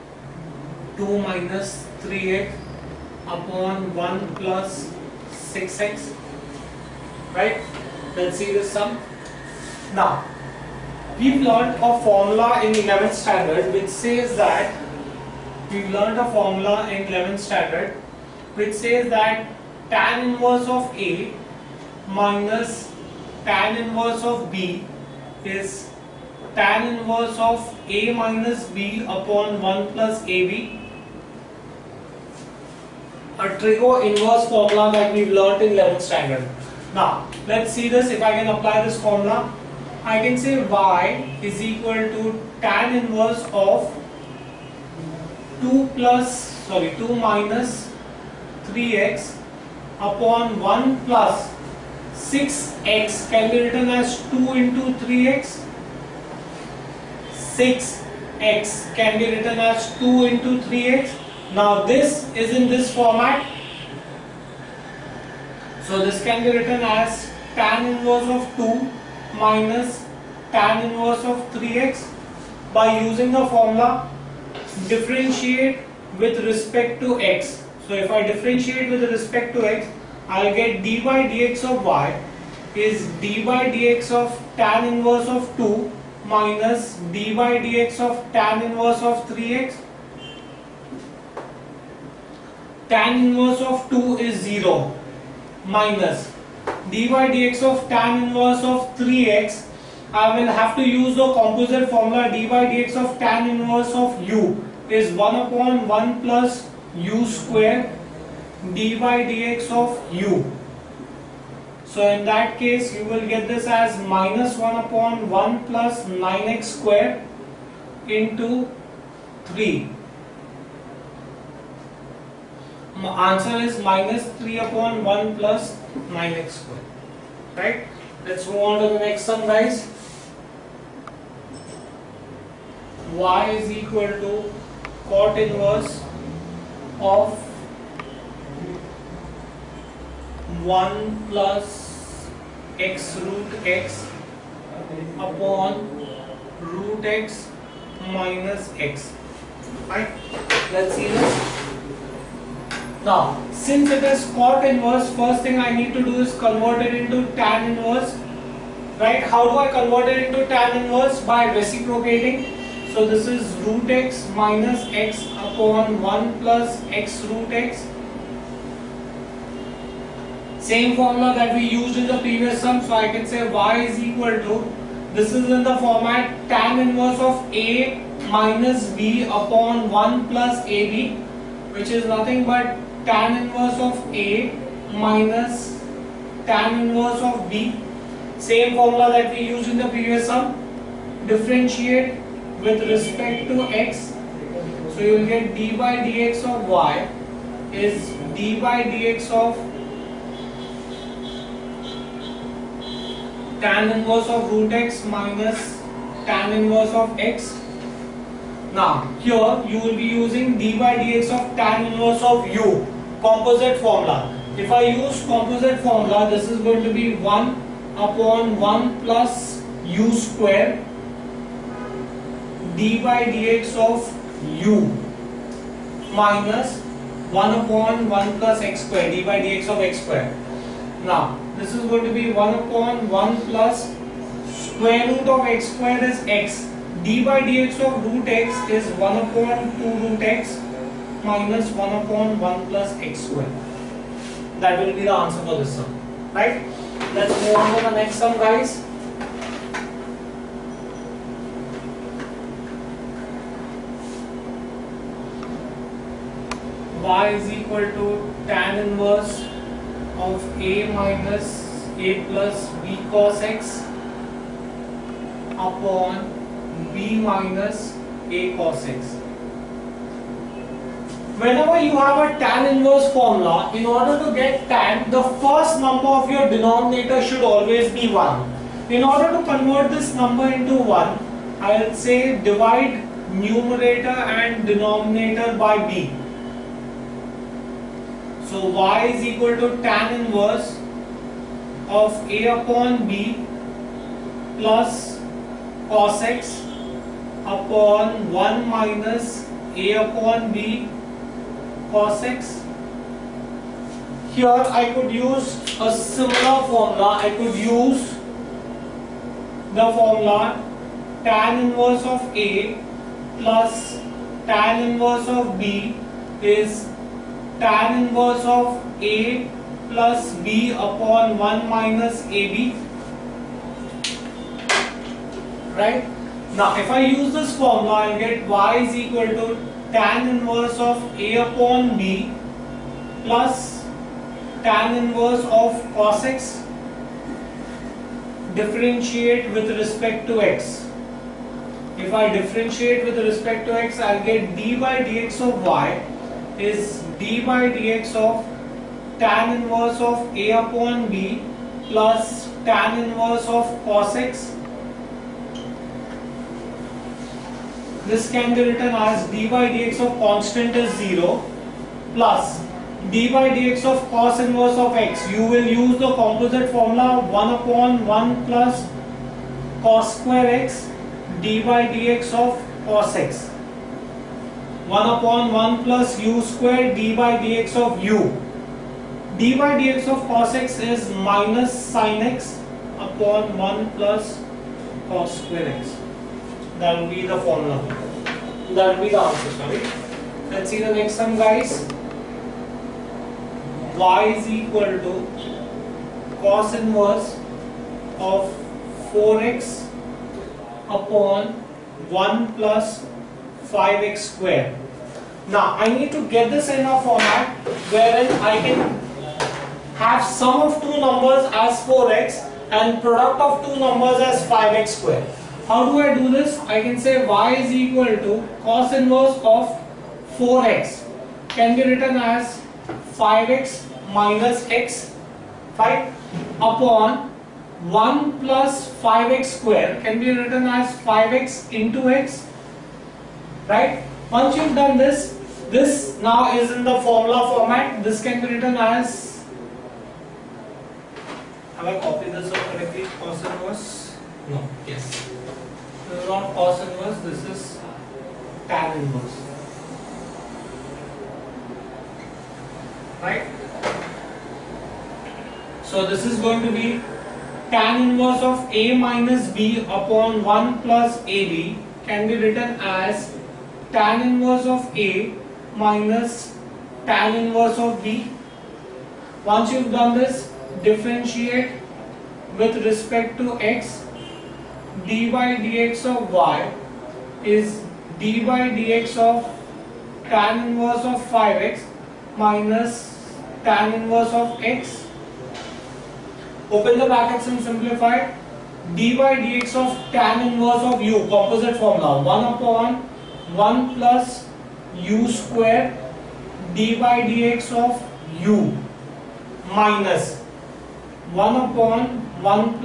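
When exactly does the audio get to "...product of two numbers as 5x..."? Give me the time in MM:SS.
06:53.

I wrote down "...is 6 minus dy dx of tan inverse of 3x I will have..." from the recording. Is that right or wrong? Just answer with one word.
wrong.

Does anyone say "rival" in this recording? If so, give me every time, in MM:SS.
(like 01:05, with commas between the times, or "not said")
not said.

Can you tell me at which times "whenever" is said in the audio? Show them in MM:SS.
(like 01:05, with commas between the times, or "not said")
04:31.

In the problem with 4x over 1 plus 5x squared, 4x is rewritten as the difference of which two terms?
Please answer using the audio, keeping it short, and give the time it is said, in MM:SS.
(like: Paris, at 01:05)
5x minus x, at 07:03.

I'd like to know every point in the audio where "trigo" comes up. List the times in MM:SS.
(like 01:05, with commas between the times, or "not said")
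00:33.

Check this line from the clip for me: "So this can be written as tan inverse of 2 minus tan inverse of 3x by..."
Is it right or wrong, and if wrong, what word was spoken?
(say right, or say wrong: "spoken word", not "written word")
right.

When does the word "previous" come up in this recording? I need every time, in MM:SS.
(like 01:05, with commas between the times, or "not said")
02:52, 03:09.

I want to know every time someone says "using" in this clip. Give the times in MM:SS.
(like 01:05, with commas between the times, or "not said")
01:12, 03:30.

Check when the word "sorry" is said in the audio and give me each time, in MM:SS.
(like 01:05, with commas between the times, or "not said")
00:46, 06:29.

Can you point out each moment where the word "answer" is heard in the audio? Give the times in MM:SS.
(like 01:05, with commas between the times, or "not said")
02:03, 04:05, 06:29.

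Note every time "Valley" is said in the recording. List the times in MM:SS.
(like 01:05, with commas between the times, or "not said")
not said.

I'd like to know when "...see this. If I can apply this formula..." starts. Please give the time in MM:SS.
00:37.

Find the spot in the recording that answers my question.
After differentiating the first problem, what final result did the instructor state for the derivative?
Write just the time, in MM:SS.
02:03.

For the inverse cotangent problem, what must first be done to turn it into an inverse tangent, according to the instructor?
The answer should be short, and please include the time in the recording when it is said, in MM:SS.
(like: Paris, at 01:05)
Reciprocating, at 02:41.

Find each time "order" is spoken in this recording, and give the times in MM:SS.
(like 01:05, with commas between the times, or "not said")
04:33, 04:39.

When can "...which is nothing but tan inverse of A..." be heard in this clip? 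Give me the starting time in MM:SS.
03:01.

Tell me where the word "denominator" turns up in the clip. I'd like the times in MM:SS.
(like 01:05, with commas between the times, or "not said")
04:36, 04:44.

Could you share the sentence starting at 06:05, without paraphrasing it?
You will use the composite formula 1 upon 1 plus cos square x dy dx of cos x.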